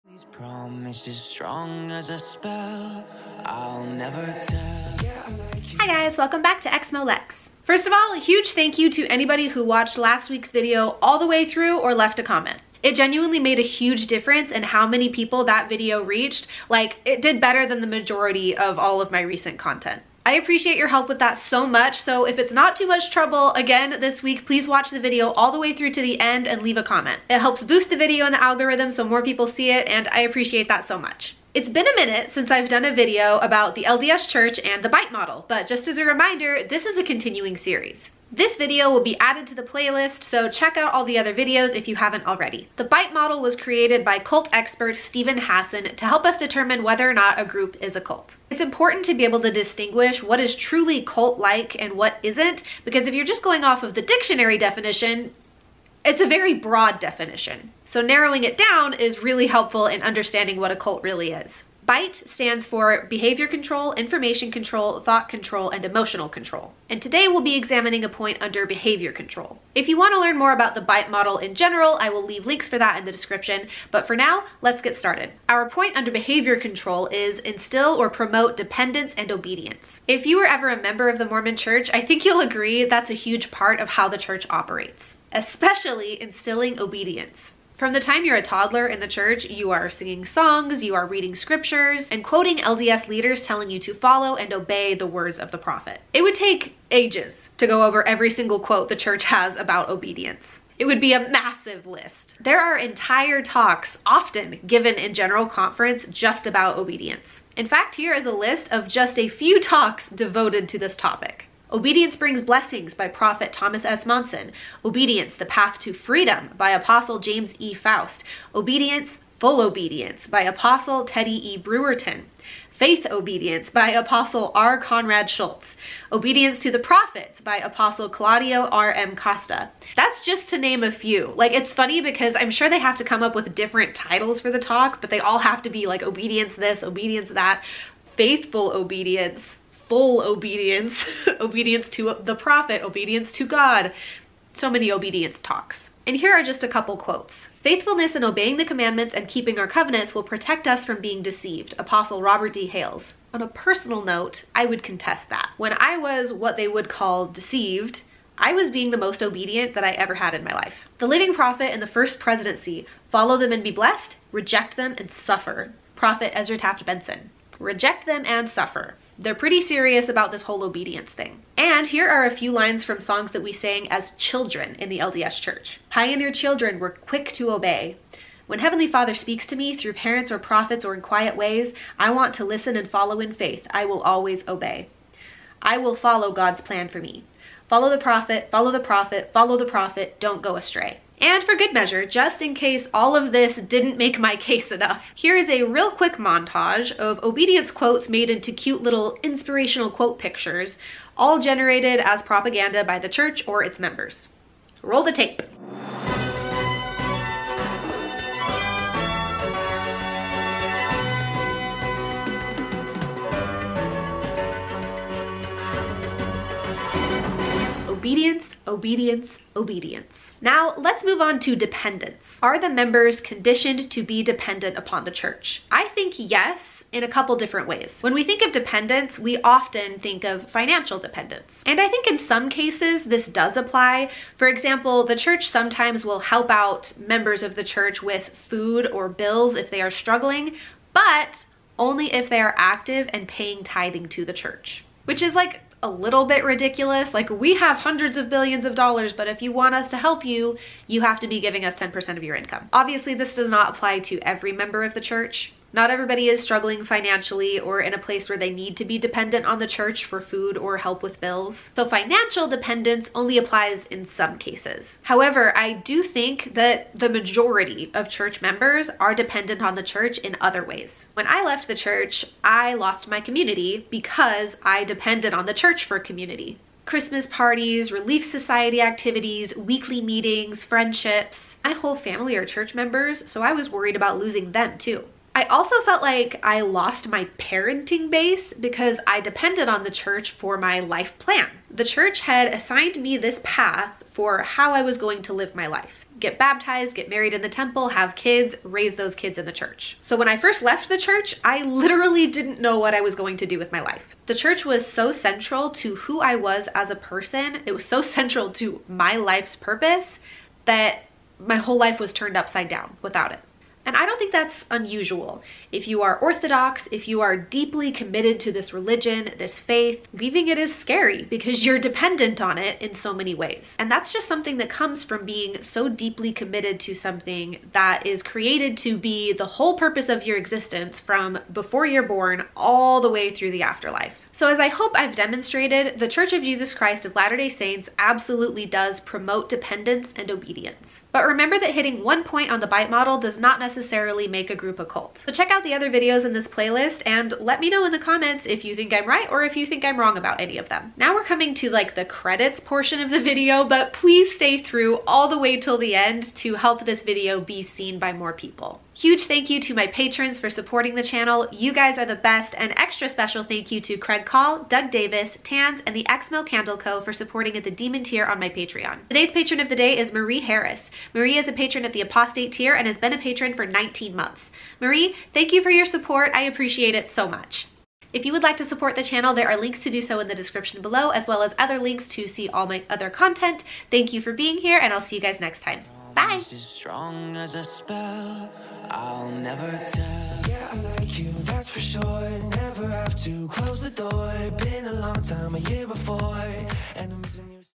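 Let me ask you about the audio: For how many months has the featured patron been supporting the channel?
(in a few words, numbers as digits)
19.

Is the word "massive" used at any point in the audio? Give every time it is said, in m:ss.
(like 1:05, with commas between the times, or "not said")
1:41.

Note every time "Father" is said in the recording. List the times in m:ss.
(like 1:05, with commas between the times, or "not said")
2:58.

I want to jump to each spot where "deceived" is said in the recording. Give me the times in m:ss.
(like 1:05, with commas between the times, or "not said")
2:31, 2:37.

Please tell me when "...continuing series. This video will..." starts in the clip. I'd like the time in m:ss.
0:37.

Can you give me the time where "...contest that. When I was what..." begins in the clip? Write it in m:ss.
2:34.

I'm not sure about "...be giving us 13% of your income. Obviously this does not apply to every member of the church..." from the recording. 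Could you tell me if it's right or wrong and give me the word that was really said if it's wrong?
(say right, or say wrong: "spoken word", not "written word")
wrong: "10", not "13".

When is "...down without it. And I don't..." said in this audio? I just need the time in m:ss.
5:12.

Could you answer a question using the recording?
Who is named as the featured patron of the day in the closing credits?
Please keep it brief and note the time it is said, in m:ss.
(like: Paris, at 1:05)
Marie Harris, at 6:10.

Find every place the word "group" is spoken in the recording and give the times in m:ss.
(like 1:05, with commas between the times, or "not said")
0:47, 5:44.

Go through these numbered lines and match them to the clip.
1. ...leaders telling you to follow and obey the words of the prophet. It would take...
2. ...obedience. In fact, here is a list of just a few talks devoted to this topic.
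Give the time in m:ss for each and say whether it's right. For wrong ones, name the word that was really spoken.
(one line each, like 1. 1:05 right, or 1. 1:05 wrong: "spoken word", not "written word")
1. 1:33 right
2. 1:46 right.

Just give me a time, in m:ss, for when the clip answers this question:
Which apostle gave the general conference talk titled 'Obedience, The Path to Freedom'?
1:57.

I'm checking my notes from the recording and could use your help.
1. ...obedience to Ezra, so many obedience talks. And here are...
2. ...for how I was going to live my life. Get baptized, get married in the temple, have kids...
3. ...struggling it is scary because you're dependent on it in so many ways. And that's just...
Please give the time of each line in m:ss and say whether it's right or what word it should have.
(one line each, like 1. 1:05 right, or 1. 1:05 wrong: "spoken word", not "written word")
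1. 2:22 wrong: "God", not "Ezra"
2. 4:54 right
3. 5:20 wrong: "leaving", not "struggling".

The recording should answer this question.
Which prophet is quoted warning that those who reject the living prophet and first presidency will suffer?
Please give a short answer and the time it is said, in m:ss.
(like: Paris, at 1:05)
Ezra Taft Benson, at 2:46.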